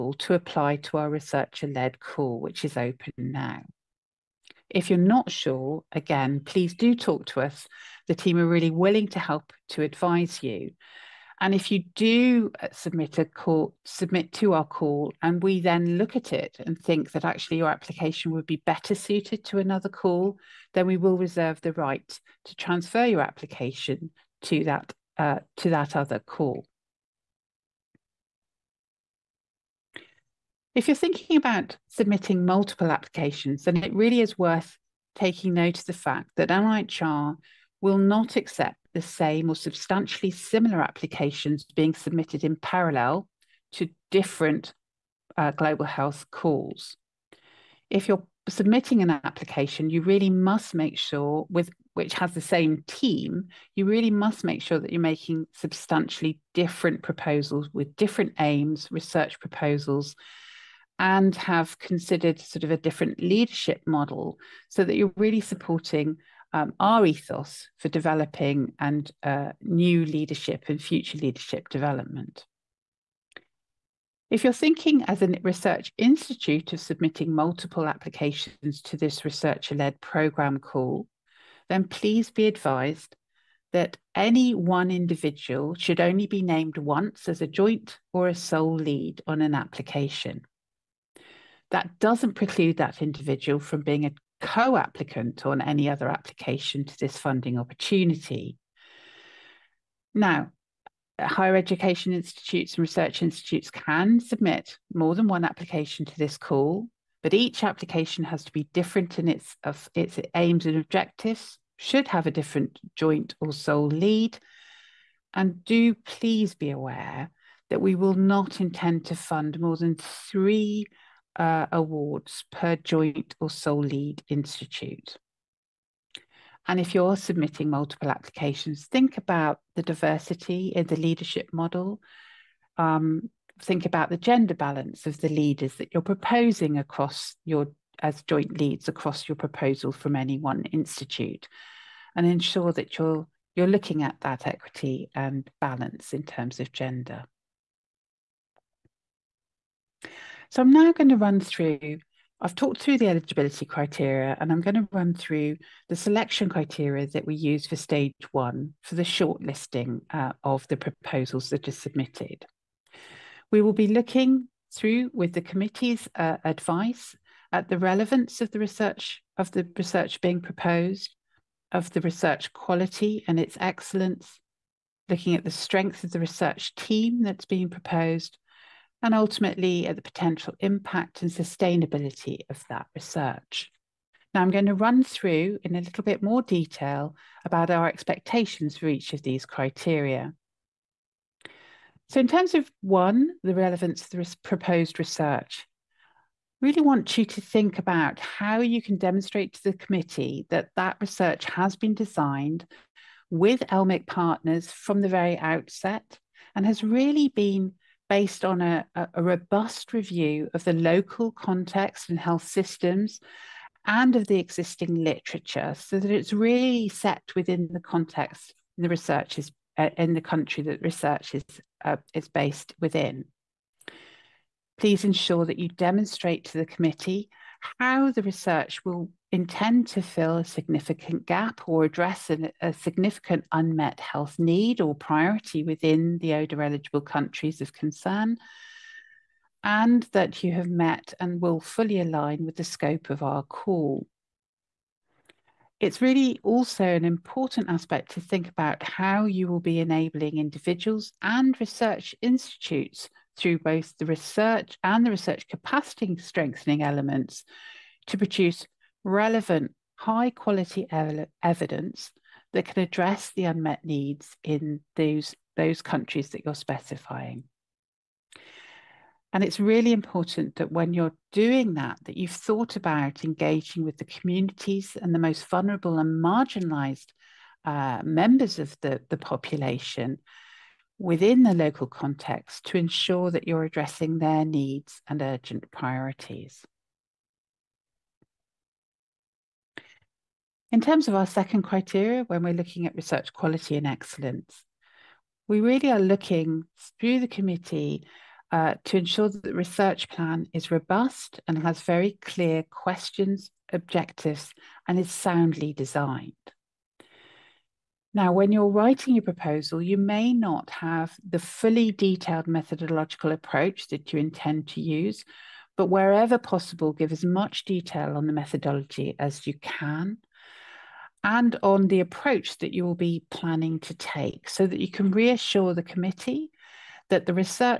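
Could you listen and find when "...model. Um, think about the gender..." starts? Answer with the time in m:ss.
2:11.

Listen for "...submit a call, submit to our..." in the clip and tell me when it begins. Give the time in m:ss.
0:12.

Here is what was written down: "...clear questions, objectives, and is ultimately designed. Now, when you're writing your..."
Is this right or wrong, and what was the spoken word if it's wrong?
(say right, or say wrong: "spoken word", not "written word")
wrong: "soundly", not "ultimately".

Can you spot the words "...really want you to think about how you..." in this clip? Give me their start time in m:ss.
3:16.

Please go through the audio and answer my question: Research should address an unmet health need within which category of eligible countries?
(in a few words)
ODA eligible countries.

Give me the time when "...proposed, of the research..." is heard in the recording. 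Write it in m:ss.
2:50.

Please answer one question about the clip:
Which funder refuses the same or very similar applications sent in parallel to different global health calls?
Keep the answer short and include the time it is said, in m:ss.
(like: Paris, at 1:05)
NIHR, at 0:36.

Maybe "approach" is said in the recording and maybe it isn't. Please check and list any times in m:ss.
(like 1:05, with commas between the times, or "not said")
5:13, 5:21.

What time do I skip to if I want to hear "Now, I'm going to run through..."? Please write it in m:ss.
3:04.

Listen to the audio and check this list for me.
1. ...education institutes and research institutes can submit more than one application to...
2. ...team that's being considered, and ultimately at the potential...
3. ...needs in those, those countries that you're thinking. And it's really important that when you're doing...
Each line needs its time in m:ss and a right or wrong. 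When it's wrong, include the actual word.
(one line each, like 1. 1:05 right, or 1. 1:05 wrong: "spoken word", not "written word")
1. 1:41 right
2. 2:56 wrong: "proposed", not "considered"
3. 4:23 wrong: "specifying", not "thinking".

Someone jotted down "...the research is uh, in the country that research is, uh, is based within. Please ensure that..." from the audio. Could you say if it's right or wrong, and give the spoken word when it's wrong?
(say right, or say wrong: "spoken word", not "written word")
right.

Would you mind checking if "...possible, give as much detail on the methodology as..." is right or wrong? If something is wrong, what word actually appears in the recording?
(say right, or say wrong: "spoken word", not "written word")
right.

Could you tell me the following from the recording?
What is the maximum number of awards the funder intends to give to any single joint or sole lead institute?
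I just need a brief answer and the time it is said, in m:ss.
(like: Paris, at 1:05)
3, at 1:59.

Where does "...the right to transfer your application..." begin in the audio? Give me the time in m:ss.
0:21.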